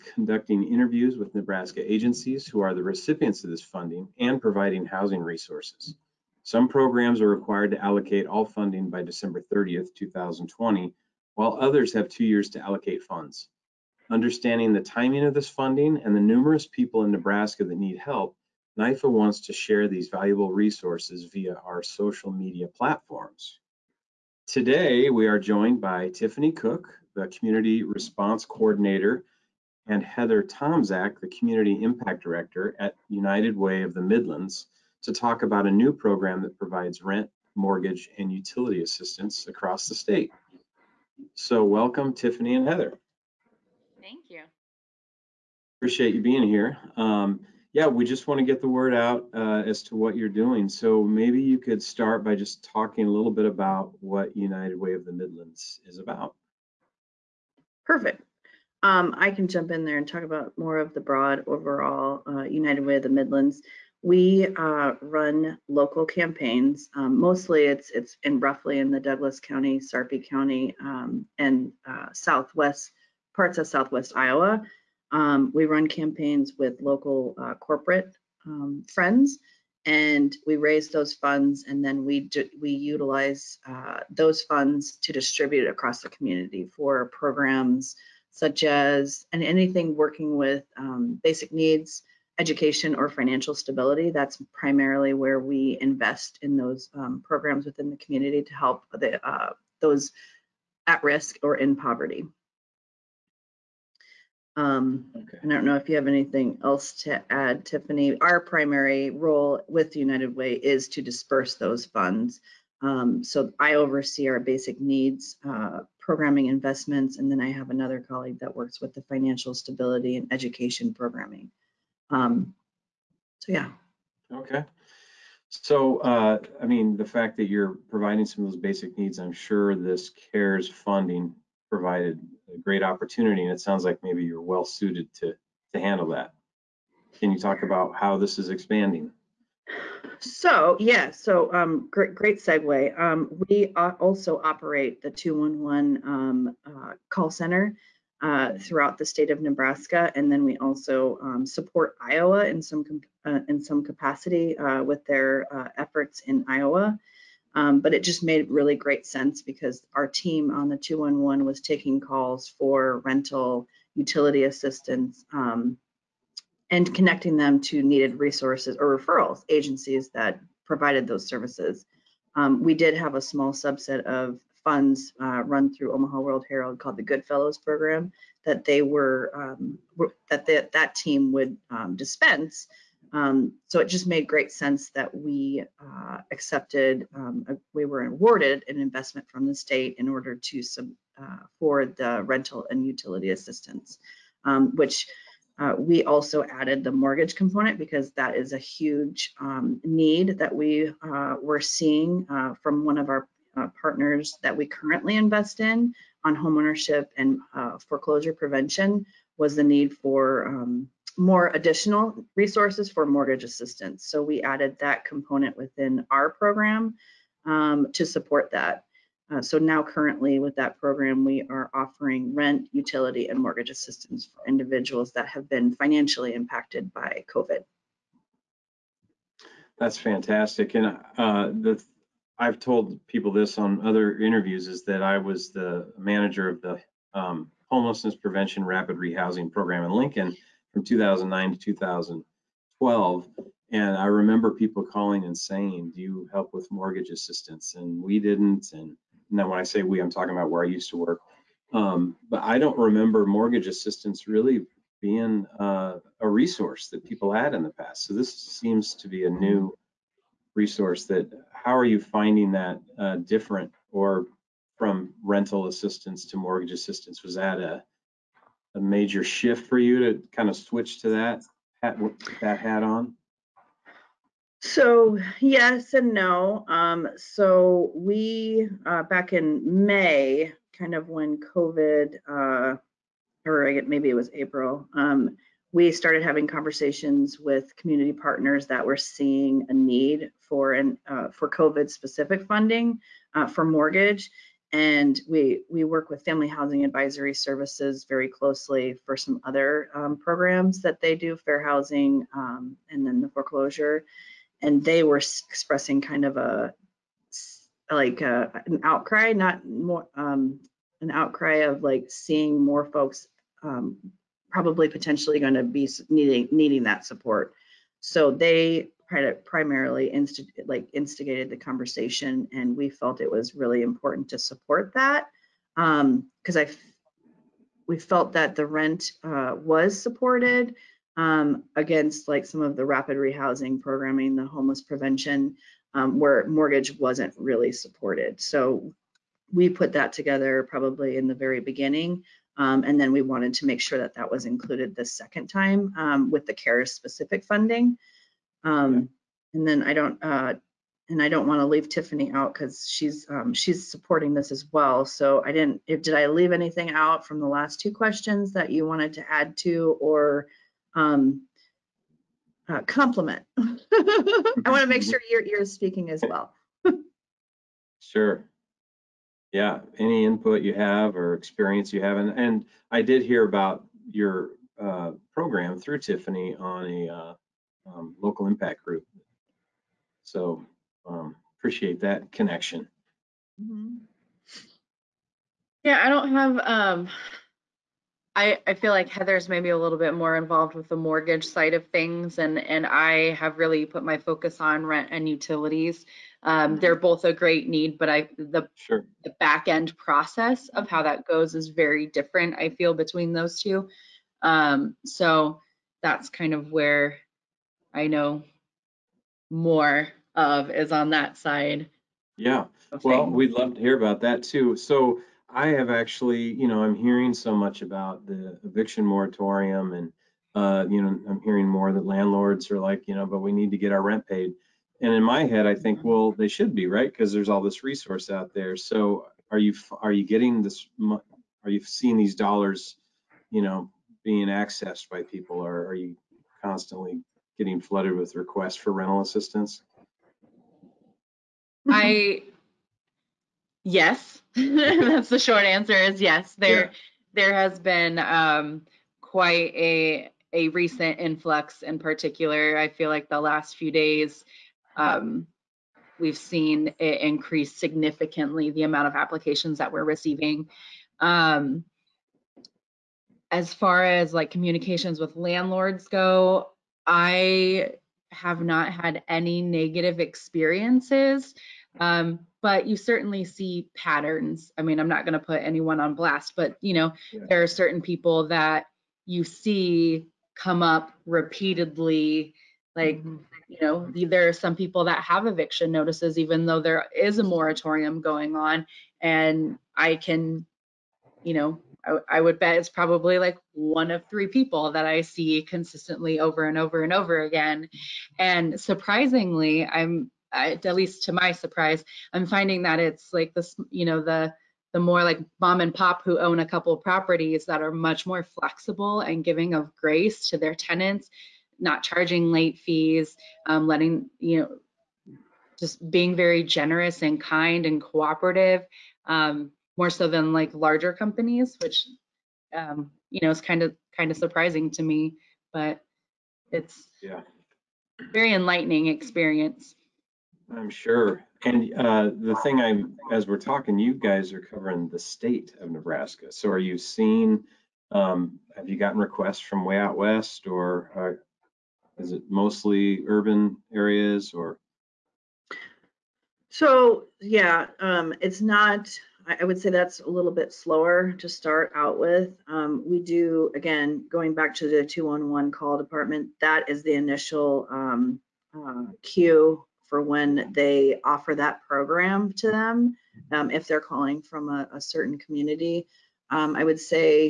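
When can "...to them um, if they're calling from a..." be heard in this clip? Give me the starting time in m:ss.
9:22.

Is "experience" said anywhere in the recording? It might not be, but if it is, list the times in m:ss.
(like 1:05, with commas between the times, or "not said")
6:11, 7:50, 8:49.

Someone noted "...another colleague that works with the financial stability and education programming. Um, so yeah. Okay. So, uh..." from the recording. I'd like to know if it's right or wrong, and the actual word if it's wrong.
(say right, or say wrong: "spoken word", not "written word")
right.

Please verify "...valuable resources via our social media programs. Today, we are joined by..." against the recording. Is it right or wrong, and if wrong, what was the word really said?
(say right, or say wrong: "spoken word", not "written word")
wrong: "platforms", not "programs".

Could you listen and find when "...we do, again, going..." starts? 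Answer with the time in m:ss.
9:13.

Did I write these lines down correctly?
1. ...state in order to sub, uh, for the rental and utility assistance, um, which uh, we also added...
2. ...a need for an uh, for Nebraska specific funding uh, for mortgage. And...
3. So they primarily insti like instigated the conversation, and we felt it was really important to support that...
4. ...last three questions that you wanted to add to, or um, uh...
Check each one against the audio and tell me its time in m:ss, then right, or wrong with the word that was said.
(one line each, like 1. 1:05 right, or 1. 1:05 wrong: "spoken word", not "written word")
1. 3:09 right
2. 4:49 wrong: "COVID", not "Nebraska"
3. 5:18 right
4. 5:57 wrong: "two", not "three".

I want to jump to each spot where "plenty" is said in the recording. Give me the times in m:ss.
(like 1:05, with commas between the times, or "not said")
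not said.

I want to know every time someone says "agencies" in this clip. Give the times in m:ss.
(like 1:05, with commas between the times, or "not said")
0:01, 2:49.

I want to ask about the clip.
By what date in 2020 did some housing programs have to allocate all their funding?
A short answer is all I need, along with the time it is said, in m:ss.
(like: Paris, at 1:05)
December 30th, at 0:09.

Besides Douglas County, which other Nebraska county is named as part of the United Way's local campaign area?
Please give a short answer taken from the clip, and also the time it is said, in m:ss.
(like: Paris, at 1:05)
Sarpy County, at 1:09.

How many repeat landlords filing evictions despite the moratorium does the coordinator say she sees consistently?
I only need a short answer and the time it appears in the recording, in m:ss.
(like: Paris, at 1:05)
3, at 8:14.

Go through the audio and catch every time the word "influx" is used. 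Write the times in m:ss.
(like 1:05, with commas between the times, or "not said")
7:31.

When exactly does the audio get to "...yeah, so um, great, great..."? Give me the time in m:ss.
2:20.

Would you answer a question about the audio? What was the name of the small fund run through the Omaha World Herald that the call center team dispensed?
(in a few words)
Goodfellows Program.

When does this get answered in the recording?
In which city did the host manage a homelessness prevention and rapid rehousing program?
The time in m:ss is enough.
3:59.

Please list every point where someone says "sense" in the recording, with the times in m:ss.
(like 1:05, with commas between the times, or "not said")
2:39, 3:04.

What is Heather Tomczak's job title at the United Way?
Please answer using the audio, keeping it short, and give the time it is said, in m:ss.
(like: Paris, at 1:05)
Community Impact Director, at 0:31.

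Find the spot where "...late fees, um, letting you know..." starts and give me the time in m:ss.
8:32.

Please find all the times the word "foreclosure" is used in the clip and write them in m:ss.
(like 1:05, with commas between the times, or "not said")
3:27, 5:03.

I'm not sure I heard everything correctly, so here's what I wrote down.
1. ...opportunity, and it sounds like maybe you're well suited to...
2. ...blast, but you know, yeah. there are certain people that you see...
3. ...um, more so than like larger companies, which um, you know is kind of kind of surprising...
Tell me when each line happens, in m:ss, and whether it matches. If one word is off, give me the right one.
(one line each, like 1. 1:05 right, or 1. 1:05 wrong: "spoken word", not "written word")
1. 2:12 right
2. 7:56 right
3. 8:39 right.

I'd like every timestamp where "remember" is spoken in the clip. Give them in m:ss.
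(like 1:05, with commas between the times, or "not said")
4:04, 4:12.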